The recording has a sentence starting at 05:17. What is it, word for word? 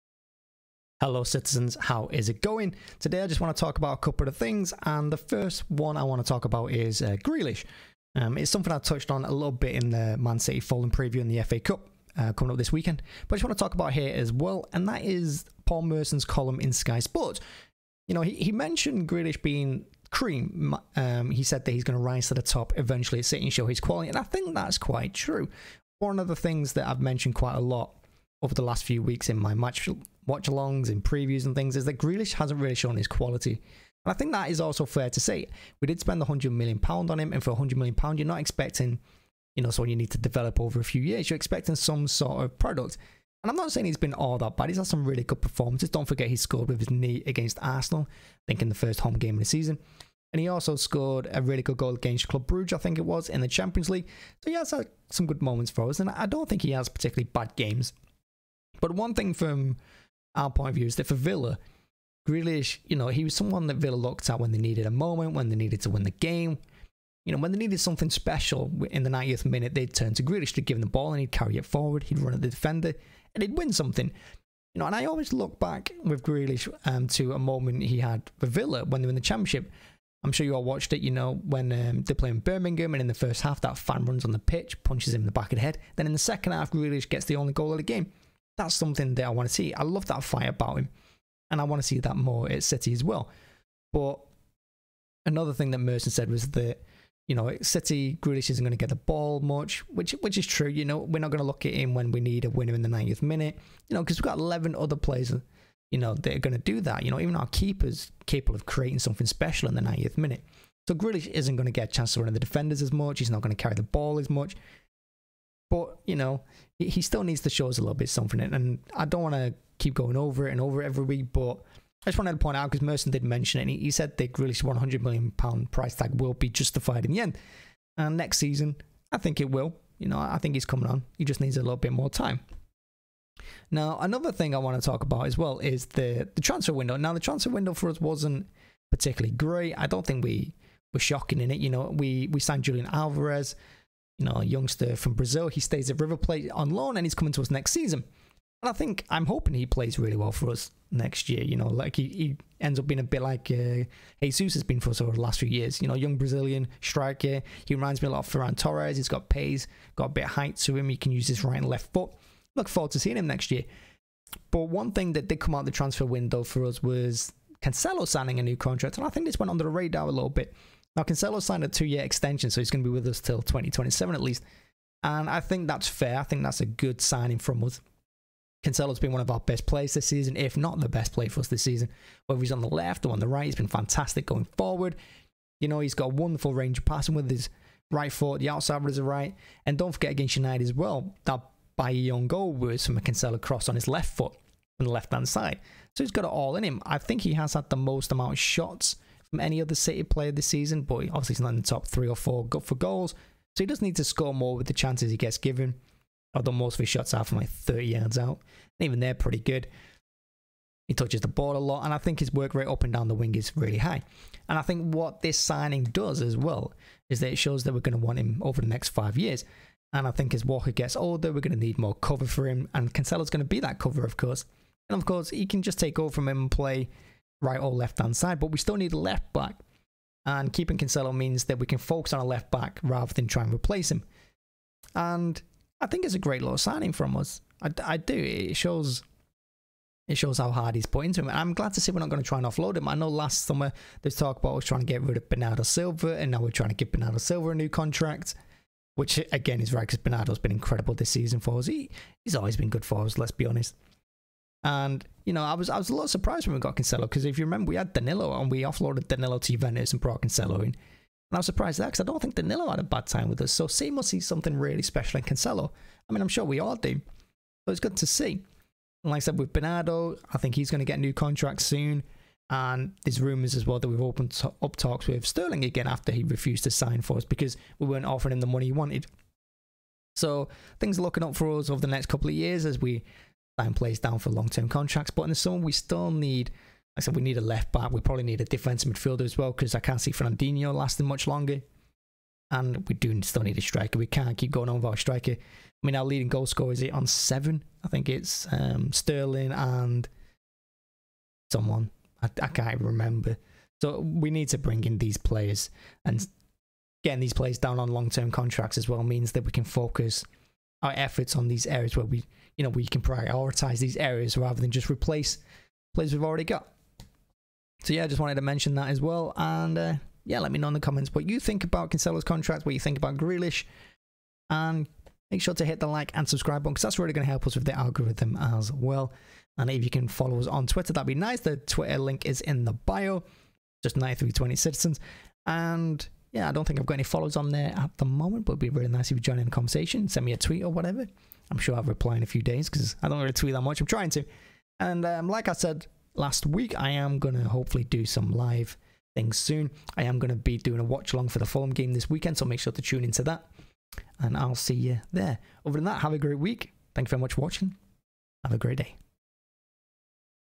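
So yeah, I just wanted to mention that as well.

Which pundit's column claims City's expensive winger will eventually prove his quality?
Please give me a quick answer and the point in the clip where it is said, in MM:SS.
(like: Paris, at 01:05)
Paul Merson, at 00:15.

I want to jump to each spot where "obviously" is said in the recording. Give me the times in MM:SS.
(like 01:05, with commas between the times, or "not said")
03:21.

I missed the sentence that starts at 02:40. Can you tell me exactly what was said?
He can use his right and left foot.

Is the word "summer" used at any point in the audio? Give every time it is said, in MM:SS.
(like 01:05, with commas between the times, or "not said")
04:03, 04:45.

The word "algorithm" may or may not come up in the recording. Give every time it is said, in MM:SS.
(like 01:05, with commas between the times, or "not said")
05:27.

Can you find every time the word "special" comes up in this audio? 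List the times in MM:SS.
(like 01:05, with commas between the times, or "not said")
01:08, 01:49, 04:24.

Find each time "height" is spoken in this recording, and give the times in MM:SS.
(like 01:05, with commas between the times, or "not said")
02:40.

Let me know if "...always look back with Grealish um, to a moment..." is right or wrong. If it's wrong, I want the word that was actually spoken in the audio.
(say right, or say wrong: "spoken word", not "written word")
right.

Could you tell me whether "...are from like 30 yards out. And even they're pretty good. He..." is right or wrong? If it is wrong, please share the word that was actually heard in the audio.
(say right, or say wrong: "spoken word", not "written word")
right.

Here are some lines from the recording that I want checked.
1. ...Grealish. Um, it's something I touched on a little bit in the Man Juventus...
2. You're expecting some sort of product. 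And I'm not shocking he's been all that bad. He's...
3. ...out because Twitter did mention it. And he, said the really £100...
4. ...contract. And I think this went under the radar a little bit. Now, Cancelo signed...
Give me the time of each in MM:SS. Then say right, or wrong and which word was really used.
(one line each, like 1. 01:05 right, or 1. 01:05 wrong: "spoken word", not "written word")
1. 00:07 wrong: "City", not "Juventus"
2. 00:41 wrong: "saying", not "shocking"
3. 02:02 wrong: "Merson", not "Twitter"
4. 02:48 right.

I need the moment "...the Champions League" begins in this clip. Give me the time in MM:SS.
00:53.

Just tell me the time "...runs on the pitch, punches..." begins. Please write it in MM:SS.
01:24.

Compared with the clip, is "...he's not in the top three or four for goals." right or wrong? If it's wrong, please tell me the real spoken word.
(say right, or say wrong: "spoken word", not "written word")
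right.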